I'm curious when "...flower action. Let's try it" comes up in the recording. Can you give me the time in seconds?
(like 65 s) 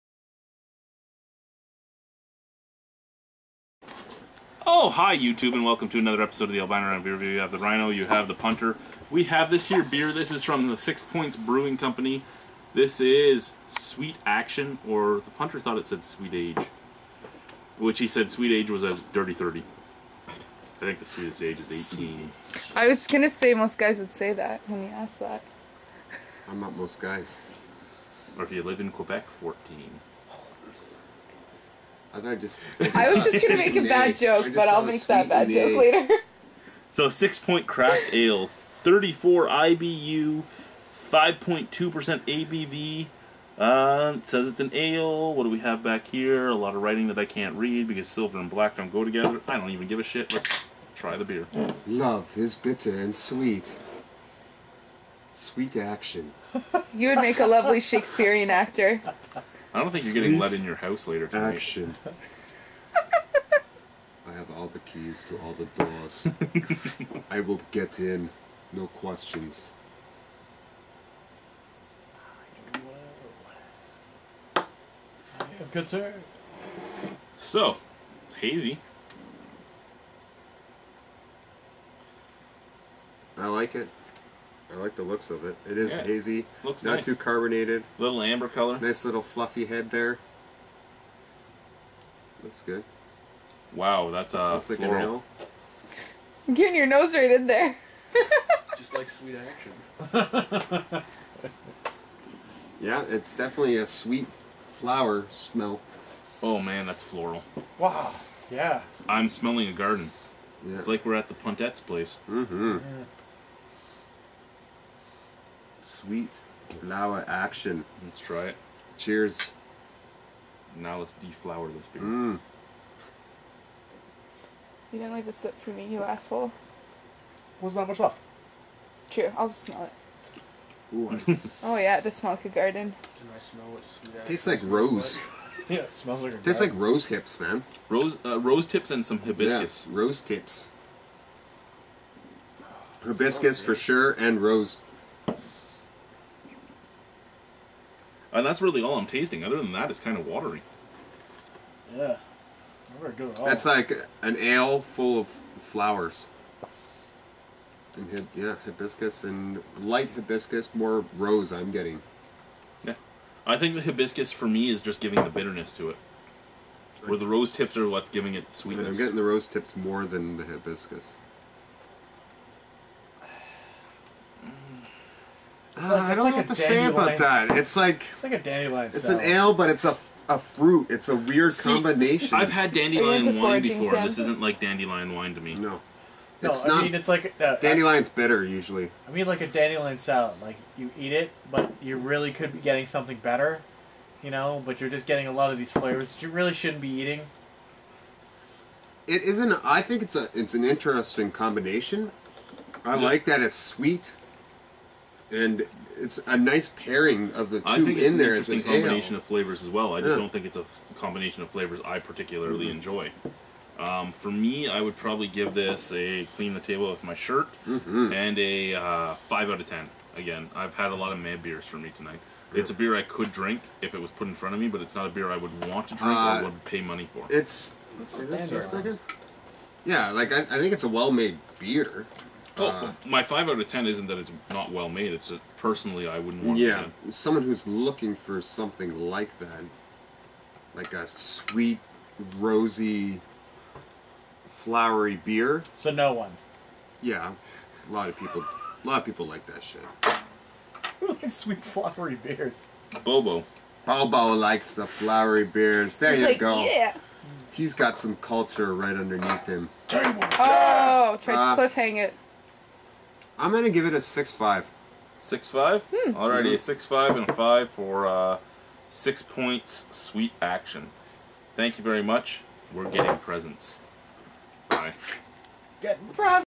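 116 s.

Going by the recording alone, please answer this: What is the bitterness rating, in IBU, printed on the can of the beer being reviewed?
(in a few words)
34.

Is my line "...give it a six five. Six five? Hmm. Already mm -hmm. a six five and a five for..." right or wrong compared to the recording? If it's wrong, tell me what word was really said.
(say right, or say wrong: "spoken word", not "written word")
right.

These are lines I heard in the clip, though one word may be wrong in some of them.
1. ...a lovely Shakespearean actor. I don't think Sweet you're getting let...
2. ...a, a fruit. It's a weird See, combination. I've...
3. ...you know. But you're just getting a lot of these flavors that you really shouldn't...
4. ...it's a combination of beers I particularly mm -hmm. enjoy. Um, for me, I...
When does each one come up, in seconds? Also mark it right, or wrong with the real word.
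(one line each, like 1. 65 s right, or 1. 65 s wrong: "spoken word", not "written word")
1. 57 s right
2. 179 s right
3. 194 s right
4. 210 s wrong: "flavors", not "beers".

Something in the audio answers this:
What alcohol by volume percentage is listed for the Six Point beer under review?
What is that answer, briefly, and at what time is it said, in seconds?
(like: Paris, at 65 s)
5.2%, at 41 s.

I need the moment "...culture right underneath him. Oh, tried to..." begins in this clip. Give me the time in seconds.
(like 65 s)
258 s.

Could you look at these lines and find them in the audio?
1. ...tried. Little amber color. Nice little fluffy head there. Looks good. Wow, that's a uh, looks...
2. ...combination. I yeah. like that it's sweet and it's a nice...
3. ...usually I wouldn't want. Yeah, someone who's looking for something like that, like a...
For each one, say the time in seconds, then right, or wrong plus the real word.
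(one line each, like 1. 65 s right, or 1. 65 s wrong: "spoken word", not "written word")
1. 87 s wrong: "carbonated", not "tried"
2. 201 s right
3. 235 s wrong: "personally", not "usually".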